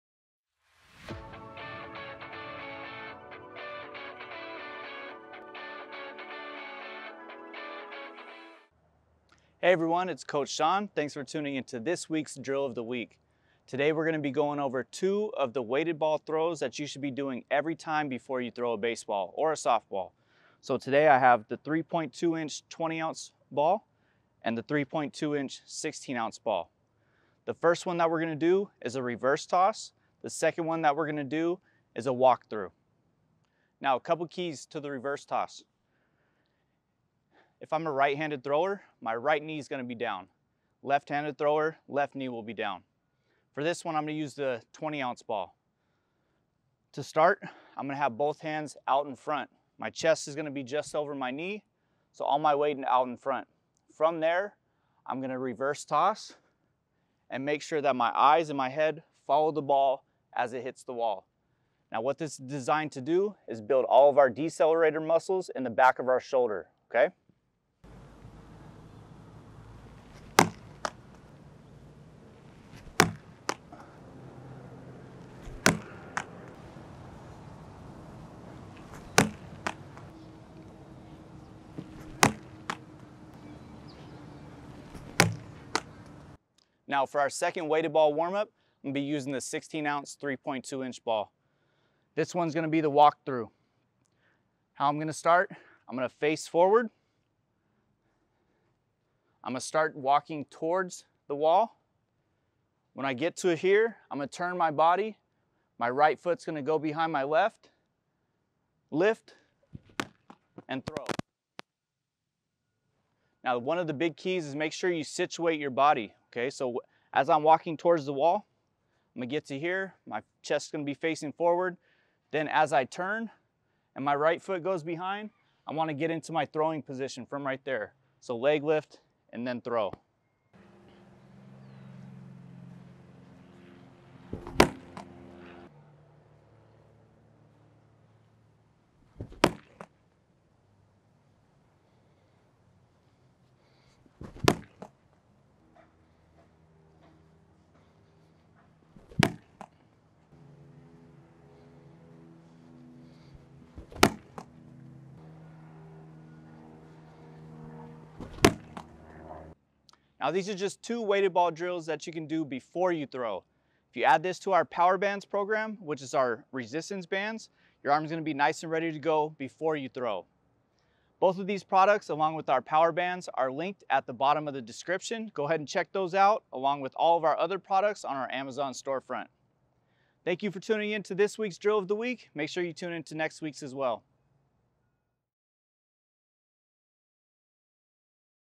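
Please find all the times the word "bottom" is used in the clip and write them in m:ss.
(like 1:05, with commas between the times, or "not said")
2:54.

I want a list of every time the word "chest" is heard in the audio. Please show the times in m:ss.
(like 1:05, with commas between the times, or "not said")
0:49, 2:00.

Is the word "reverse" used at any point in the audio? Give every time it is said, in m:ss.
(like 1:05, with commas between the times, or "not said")
0:29, 0:34, 0:55.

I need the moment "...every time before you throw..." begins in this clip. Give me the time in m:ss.
0:17.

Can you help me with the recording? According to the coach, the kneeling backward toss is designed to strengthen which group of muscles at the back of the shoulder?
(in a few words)
decelerator muscles.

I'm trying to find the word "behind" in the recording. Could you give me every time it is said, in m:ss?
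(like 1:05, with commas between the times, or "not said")
1:46, 2:04.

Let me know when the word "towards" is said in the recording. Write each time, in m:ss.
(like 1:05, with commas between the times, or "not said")
1:40, 1:57.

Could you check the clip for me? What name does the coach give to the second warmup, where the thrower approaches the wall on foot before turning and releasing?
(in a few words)
walkthrough.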